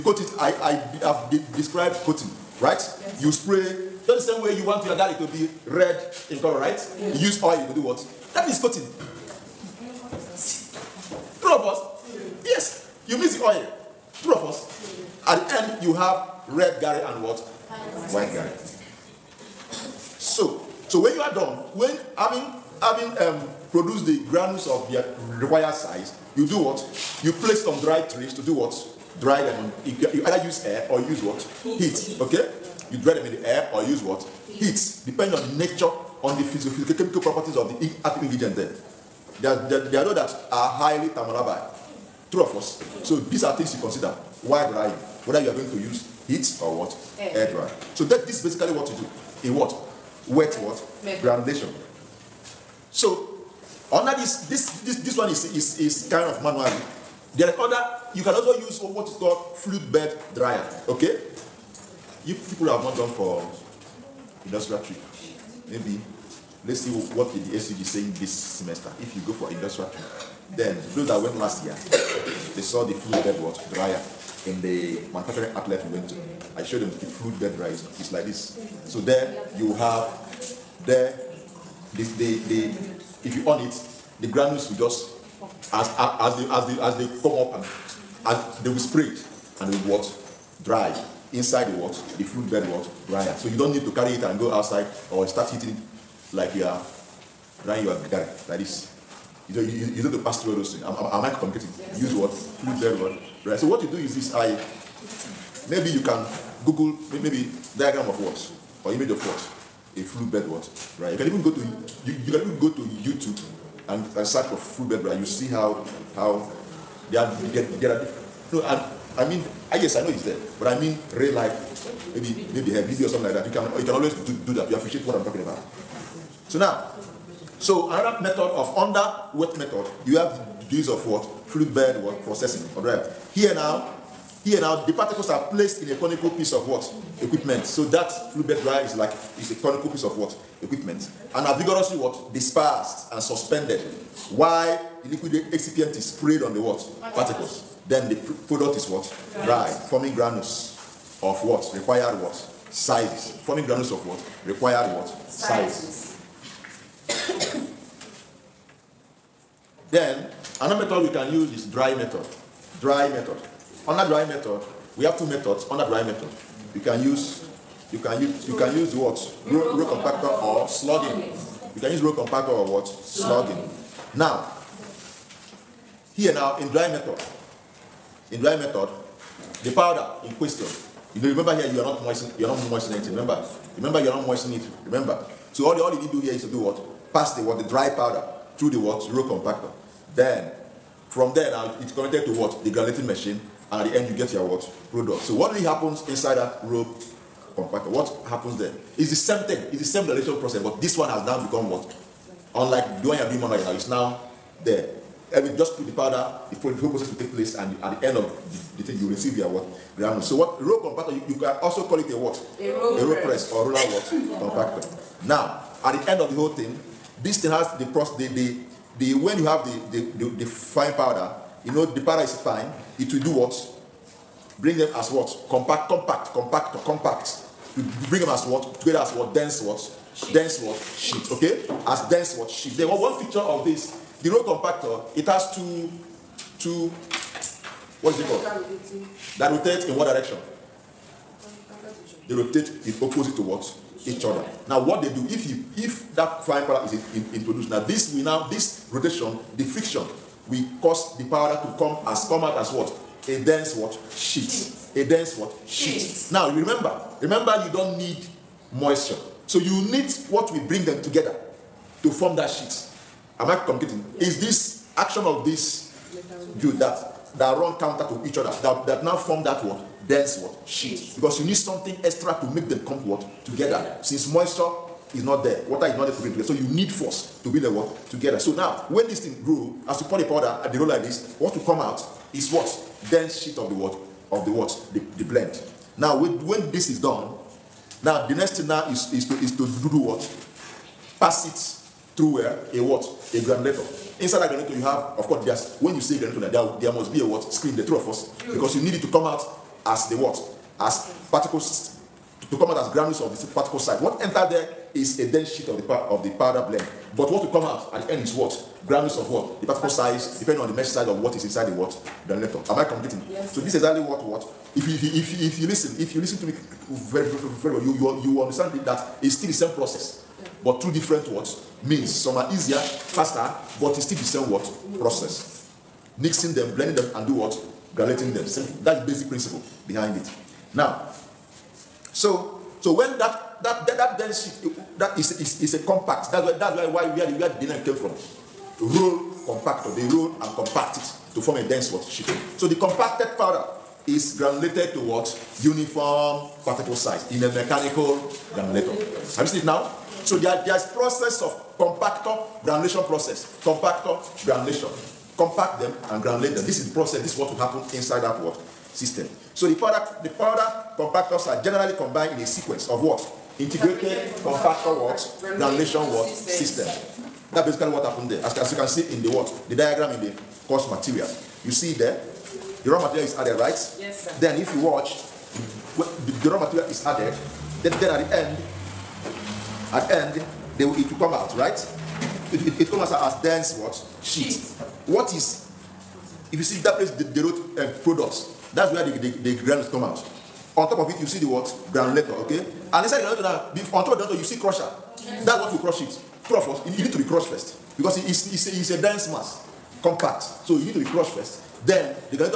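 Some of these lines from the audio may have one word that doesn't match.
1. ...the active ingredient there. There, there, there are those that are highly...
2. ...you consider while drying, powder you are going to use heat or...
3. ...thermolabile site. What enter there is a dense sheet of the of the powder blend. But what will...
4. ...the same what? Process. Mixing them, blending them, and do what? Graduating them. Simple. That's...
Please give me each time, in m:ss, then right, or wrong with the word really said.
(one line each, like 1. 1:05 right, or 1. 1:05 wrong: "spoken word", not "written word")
1. 0:37 right
2. 0:43 wrong: "whether", not "powder"
3. 5:03 wrong: "particle", not "thermolabile"
4. 5:24 right.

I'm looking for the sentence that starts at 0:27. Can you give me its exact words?
You place some dried trees to do what?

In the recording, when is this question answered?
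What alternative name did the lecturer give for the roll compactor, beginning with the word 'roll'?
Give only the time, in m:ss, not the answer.
3:32.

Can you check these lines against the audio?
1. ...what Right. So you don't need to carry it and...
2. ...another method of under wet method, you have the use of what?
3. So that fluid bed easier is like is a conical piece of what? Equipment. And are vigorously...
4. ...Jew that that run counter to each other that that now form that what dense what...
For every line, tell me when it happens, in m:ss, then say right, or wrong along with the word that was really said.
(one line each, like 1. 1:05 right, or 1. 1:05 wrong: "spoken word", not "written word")
1. 1:32 right
2. 2:07 right
3. 2:17 wrong: "dryer", not "easier"
4. 4:26 right.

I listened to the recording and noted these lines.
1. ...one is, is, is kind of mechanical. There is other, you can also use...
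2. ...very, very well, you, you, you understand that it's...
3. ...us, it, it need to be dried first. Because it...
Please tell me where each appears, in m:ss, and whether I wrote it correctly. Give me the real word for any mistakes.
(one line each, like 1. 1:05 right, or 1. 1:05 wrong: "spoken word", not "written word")
1. 0:55 wrong: "manual", not "mechanical"
2. 5:17 right
3. 6:36 wrong: "crushed", not "dried".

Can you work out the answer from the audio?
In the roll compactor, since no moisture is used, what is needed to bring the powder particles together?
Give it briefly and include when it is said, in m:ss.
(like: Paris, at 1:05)
Force, at 4:36.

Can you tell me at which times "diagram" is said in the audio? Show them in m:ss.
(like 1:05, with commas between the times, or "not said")
1:47, 6:09.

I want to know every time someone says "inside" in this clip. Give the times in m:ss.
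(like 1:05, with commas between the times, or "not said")
1:31, 3:16, 4:54, 5:11, 5:57, 6:33.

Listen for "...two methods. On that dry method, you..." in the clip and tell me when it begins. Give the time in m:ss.
2:45.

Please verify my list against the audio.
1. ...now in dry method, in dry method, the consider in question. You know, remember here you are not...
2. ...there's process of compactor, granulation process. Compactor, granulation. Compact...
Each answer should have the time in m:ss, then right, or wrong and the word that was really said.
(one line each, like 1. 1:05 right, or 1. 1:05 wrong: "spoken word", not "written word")
1. 2:56 wrong: "powder", not "consider"
2. 5:50 right.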